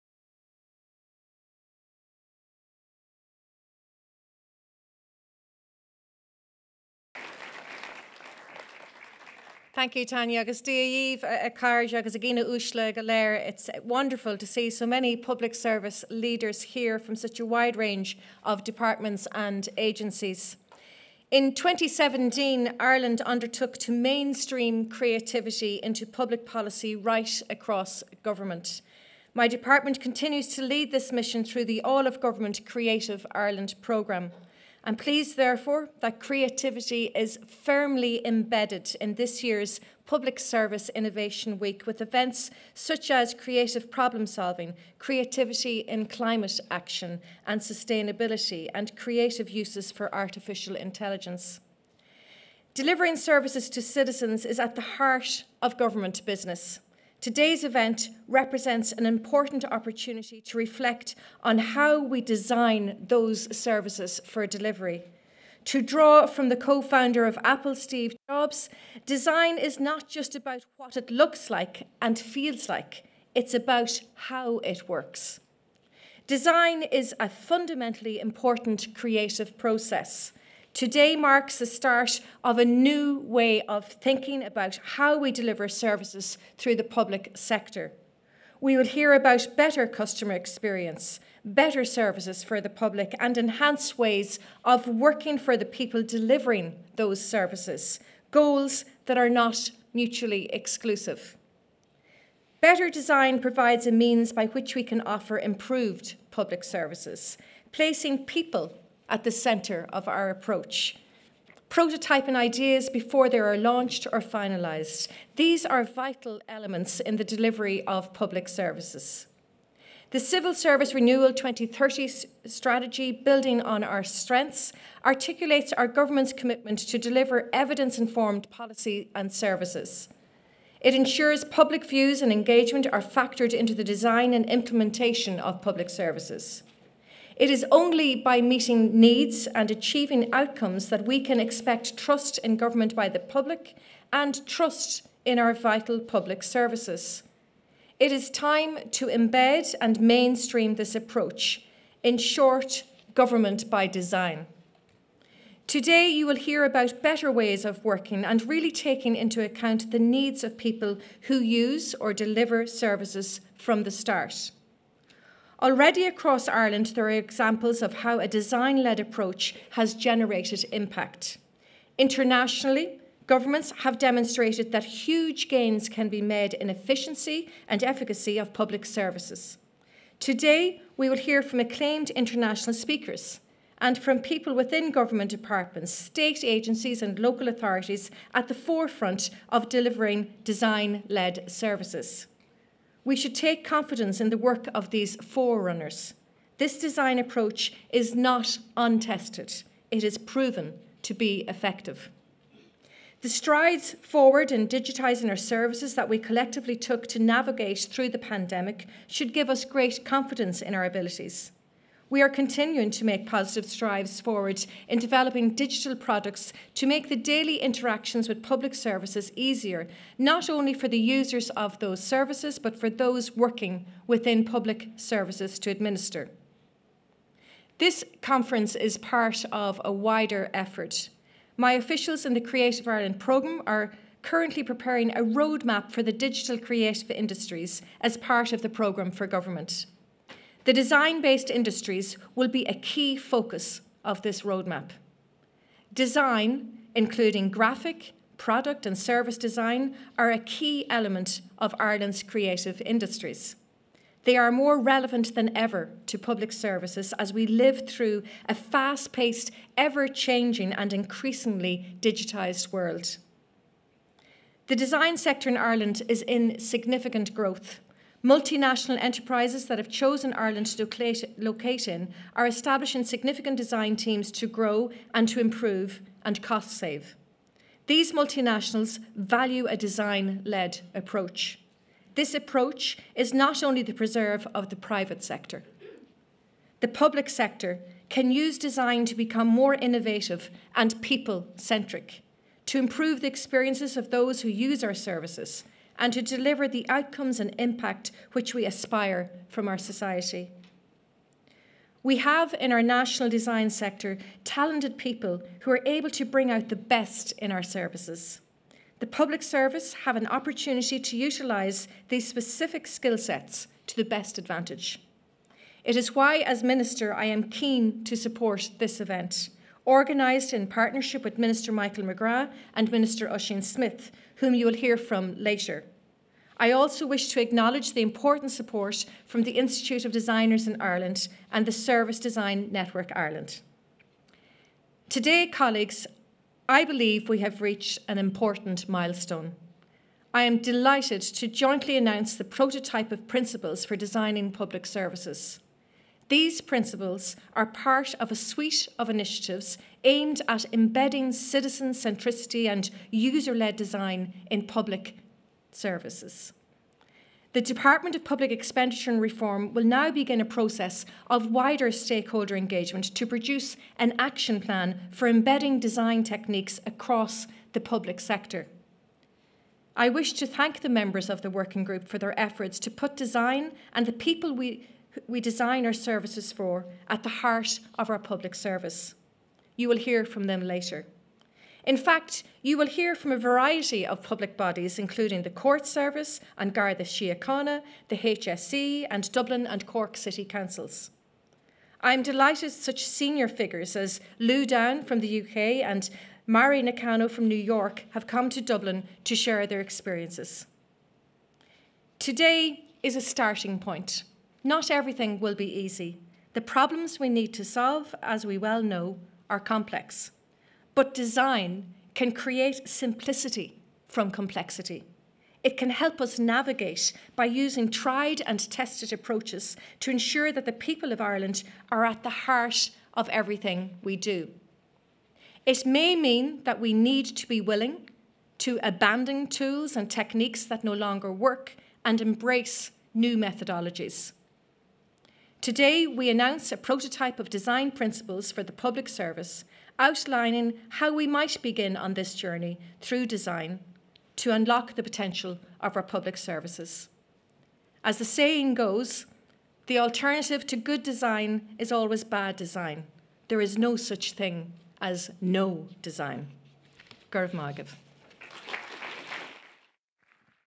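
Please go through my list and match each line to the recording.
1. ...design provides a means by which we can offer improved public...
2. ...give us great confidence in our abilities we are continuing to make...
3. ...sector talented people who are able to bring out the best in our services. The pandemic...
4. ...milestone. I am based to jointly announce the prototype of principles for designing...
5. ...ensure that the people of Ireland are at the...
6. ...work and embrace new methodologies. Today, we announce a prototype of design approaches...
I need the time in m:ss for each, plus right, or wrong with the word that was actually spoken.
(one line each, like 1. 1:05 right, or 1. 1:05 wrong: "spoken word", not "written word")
1. 1:42 right
2. 3:29 right
3. 5:03 wrong: "public", not "pandemic"
4. 5:38 wrong: "delighted", not "based"
5. 7:00 right
6. 7:11 wrong: "principles", not "approaches".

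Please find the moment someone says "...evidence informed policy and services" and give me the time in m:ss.
2:07.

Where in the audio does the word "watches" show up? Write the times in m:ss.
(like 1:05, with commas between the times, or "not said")
not said.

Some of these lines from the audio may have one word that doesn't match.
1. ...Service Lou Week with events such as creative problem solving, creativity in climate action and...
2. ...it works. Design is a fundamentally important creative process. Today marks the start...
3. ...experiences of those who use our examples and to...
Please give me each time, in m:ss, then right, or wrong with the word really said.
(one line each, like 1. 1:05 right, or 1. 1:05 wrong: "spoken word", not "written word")
1. 0:40 wrong: "Innovation", not "Lou"
2. 1:14 right
3. 4:53 wrong: "services", not "examples".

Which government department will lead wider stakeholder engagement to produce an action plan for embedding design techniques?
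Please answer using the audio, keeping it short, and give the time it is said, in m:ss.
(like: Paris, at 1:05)
Department of Public Expenditure and Reform, at 5:57.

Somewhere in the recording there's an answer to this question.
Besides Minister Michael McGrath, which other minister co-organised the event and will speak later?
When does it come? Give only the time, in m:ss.
5:23.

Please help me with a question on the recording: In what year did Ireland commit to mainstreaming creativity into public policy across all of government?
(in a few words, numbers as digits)
2017.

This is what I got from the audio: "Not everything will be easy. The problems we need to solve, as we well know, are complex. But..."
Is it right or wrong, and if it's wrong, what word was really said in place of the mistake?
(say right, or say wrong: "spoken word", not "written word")
right.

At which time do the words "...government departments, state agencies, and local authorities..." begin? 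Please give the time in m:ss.
3:04.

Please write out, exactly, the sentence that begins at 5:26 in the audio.
I also wish to acknowledge the important support from the Institute of Designers in Ireland and the Service Design Network Ireland.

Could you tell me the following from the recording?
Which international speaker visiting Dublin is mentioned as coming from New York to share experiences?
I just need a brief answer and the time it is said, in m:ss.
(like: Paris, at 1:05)
Mari Nakano, at 6:36.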